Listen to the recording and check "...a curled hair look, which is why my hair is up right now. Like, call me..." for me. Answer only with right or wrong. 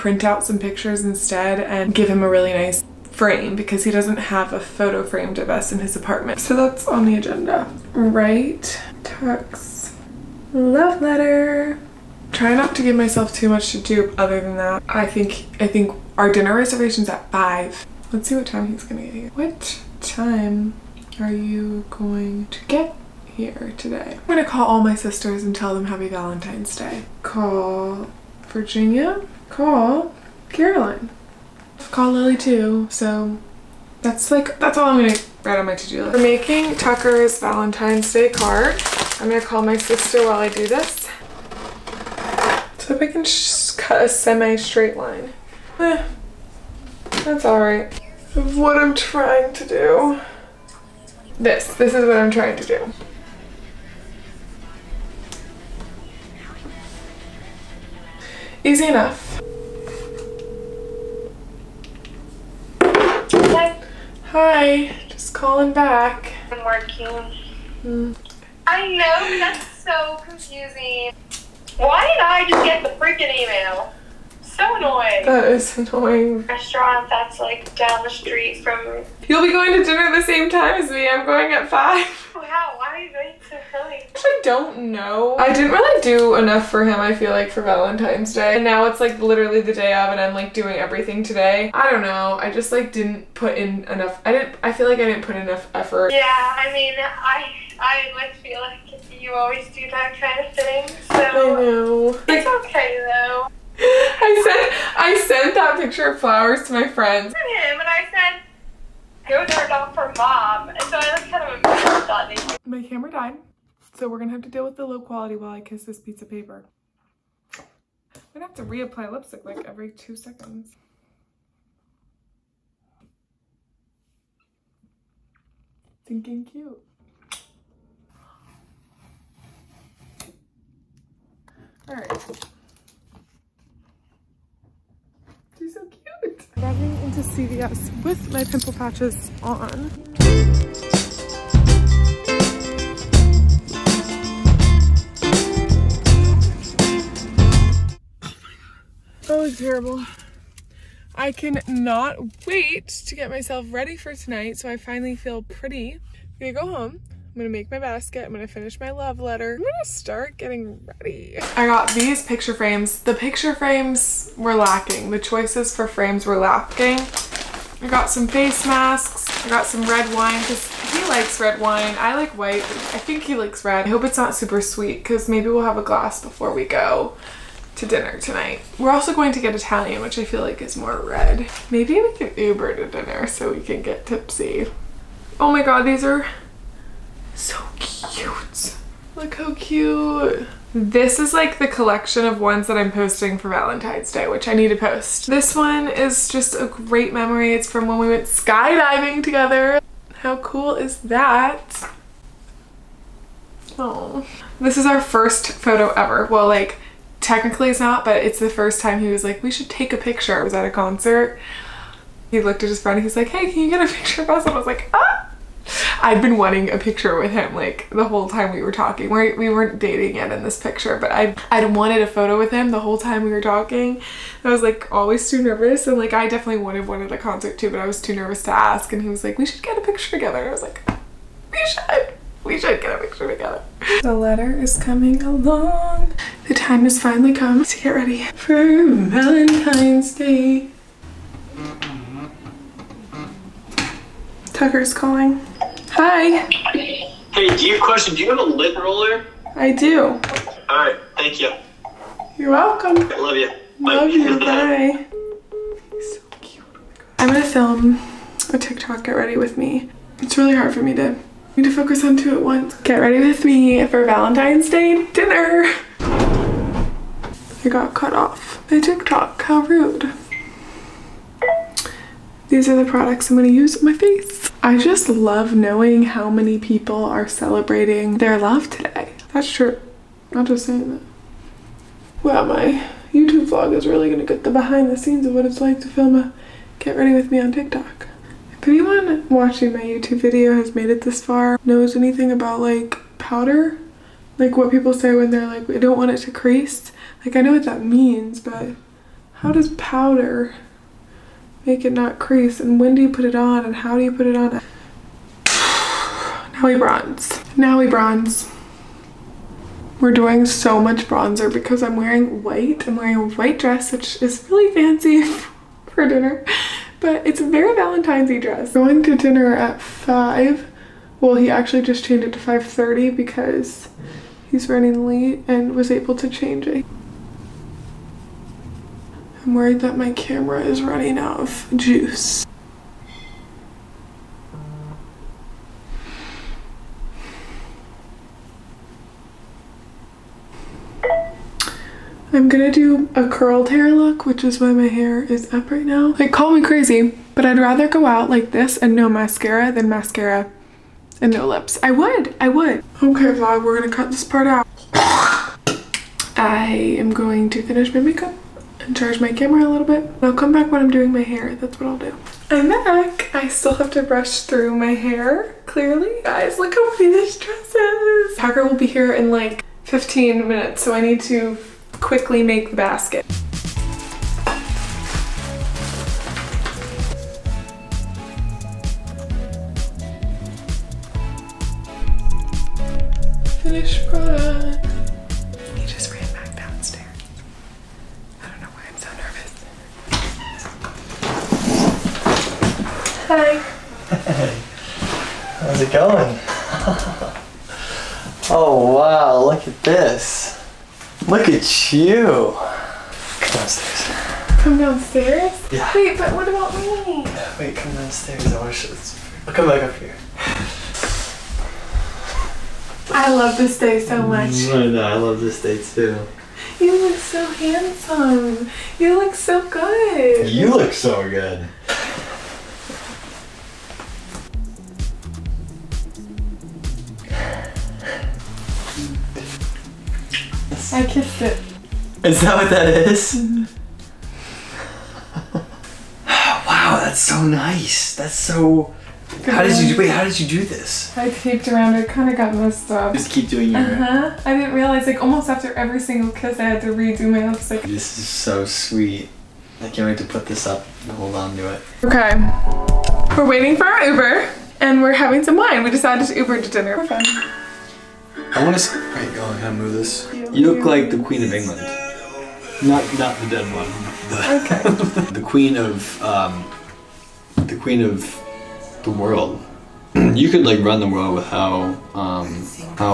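right.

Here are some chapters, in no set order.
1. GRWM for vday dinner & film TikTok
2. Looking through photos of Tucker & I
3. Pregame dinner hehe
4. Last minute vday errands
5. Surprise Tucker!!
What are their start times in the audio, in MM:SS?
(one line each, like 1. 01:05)
1. 03:55
2. 03:00
3. 07:31
4. 02:16
5. 06:31.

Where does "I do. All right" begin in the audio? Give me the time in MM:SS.
04:09.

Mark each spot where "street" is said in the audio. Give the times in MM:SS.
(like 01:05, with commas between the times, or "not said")
01:18.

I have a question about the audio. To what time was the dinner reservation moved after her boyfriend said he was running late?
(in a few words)
5:30.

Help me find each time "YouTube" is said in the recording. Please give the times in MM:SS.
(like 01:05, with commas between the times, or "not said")
04:43, 04:49.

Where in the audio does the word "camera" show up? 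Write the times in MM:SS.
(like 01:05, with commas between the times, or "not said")
01:52, 05:30, 05:59.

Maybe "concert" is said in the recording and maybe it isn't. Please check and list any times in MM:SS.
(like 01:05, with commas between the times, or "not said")
03:30, 03:47.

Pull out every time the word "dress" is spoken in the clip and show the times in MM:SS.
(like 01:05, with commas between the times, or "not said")
05:13, 05:18, 06:07.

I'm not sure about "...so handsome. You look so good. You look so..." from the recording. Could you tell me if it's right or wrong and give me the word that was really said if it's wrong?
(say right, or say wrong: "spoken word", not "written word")
right.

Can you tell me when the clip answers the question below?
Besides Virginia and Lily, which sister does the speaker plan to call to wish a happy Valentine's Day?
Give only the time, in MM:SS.
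00:30.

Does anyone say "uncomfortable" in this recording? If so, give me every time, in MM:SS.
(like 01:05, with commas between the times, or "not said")
not said.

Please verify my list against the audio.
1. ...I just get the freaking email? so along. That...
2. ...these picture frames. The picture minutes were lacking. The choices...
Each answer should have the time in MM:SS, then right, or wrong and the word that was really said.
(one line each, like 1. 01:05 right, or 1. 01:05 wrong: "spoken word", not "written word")
1. 01:12 wrong: "annoying", not "along"
2. 02:41 wrong: "frames", not "minutes".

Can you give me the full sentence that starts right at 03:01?
Maybe we can Uber to dinner so we can get tipsy.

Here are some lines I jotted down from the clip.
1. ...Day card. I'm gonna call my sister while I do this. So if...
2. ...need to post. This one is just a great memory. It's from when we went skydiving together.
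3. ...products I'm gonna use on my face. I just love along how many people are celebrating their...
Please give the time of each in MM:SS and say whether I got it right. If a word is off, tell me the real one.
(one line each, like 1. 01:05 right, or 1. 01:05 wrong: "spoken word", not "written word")
1. 00:38 right
2. 03:14 right
3. 04:32 wrong: "knowing", not "along".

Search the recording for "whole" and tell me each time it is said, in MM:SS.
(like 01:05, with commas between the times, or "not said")
03:38, 03:42.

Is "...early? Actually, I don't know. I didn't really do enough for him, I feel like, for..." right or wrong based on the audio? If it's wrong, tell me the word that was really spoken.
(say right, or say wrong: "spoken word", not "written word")
right.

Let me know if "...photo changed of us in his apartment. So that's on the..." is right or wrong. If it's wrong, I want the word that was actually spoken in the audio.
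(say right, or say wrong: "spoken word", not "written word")
wrong: "framed", not "changed".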